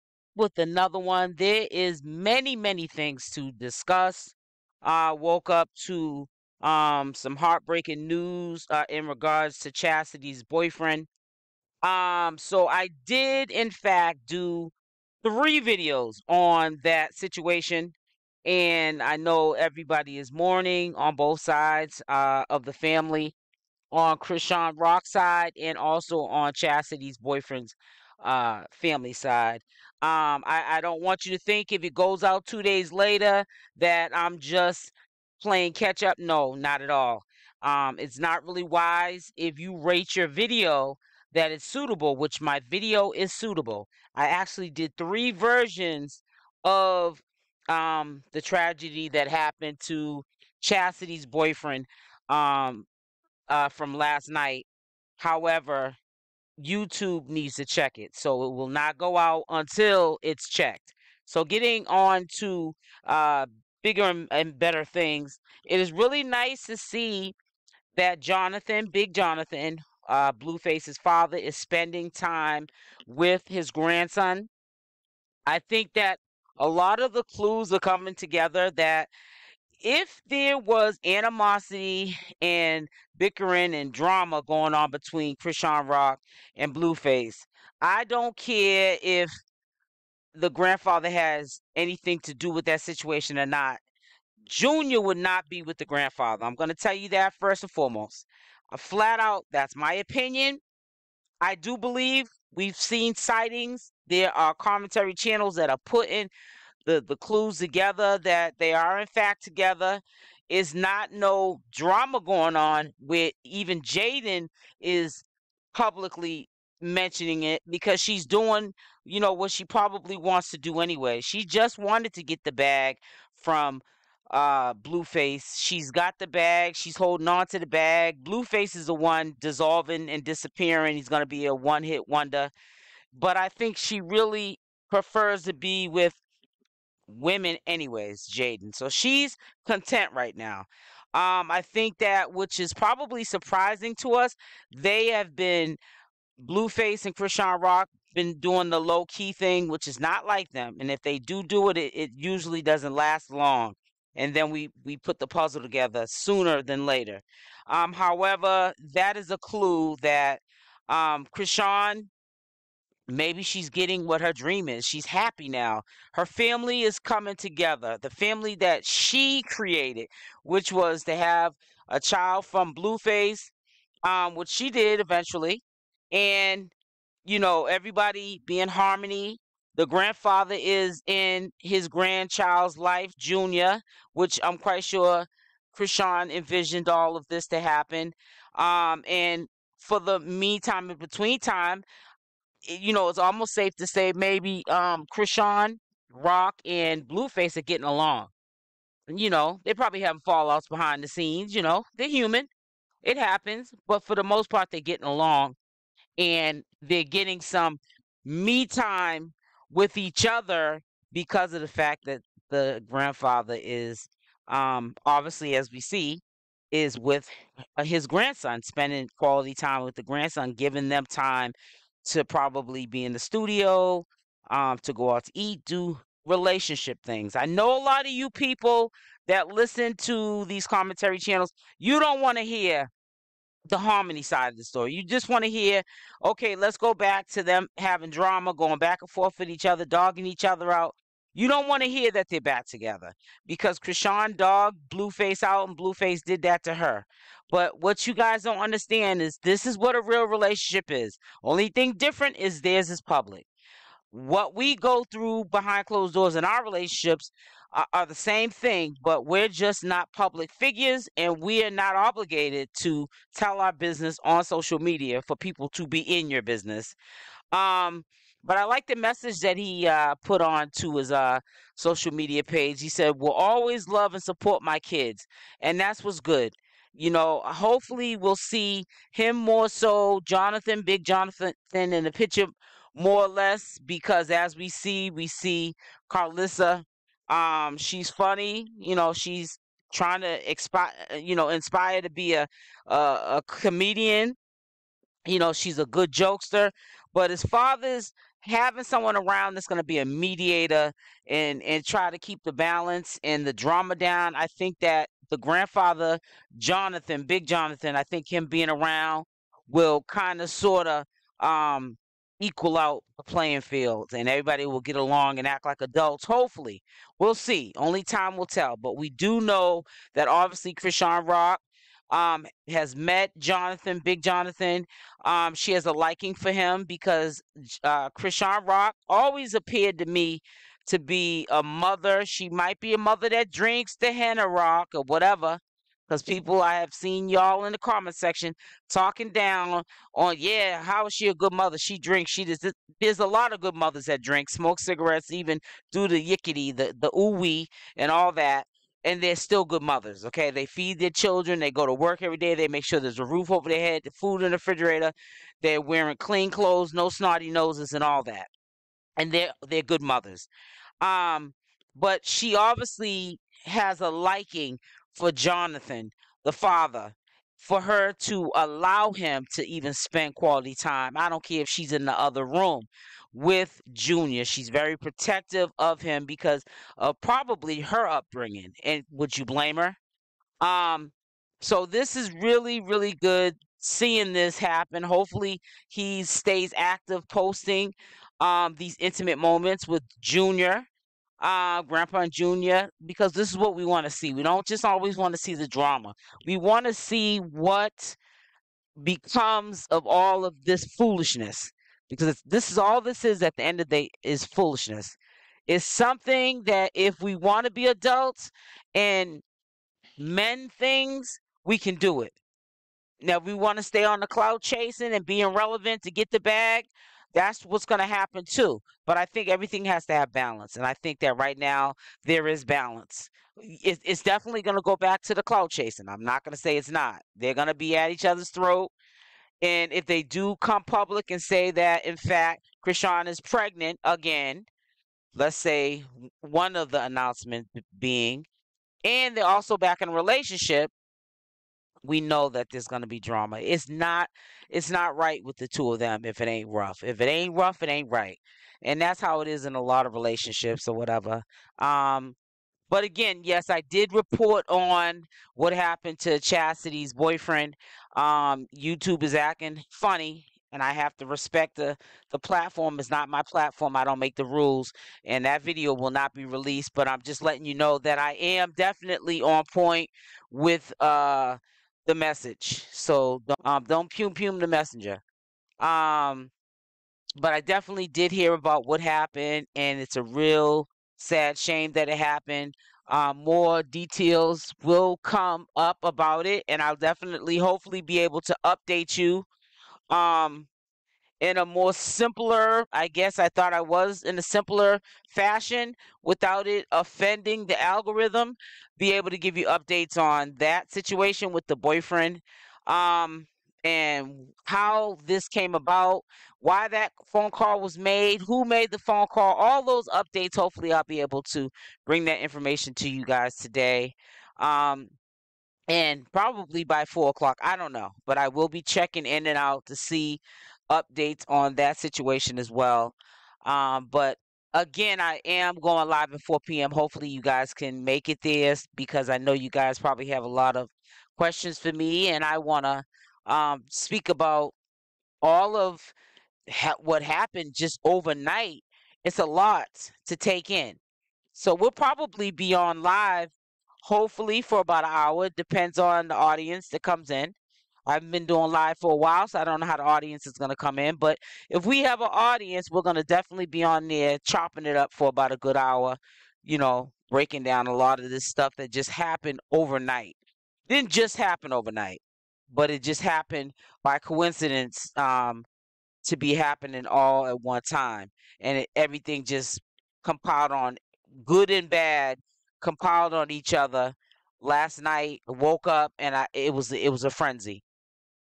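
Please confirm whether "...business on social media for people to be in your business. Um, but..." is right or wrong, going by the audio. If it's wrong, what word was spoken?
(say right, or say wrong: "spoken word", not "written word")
right.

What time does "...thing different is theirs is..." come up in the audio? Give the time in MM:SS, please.
04:11.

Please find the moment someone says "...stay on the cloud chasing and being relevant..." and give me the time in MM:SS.
06:53.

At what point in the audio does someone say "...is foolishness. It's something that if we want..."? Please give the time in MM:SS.
06:44.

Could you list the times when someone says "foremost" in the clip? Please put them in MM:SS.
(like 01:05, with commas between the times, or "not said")
01:37.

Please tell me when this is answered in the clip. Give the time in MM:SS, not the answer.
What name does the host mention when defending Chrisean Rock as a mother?
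05:34.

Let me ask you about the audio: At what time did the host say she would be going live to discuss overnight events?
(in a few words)
4 p.m.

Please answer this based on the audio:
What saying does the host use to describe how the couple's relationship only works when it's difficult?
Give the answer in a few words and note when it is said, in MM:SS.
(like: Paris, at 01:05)
If it ain't rough, it ain't right, at 07:27.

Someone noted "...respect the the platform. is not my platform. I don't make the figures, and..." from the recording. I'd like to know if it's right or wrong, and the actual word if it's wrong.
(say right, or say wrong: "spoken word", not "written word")
wrong: "rules", not "figures".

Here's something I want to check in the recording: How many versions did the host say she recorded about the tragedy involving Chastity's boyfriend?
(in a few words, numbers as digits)
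3.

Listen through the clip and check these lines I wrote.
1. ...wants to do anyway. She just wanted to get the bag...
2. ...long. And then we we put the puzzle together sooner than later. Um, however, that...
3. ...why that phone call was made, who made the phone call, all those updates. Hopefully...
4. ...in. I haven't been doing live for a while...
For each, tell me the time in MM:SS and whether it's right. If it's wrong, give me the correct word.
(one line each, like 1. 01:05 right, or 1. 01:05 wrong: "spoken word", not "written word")
1. 02:00 right
2. 02:33 right
3. 08:26 right
4. 09:07 right.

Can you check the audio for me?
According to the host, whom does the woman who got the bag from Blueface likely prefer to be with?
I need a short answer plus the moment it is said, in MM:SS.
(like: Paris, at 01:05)
women, at 02:17.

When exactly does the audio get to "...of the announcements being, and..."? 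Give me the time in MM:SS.
07:16.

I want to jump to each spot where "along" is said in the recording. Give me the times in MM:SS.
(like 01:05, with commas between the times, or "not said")
03:17, 03:25, 05:14.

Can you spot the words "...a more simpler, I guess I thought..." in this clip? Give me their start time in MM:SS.
08:11.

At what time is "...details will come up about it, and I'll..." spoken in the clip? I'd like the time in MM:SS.
08:03.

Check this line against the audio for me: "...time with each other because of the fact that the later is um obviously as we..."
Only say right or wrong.
wrong.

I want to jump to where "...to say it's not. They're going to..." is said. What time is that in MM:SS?
07:06.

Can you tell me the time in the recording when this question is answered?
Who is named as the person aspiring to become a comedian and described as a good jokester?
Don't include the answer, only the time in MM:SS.
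04:46.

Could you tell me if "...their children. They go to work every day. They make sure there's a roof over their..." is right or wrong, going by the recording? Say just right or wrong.
right.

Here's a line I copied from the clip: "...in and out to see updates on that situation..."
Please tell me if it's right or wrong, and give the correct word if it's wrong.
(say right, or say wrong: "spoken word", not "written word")
right.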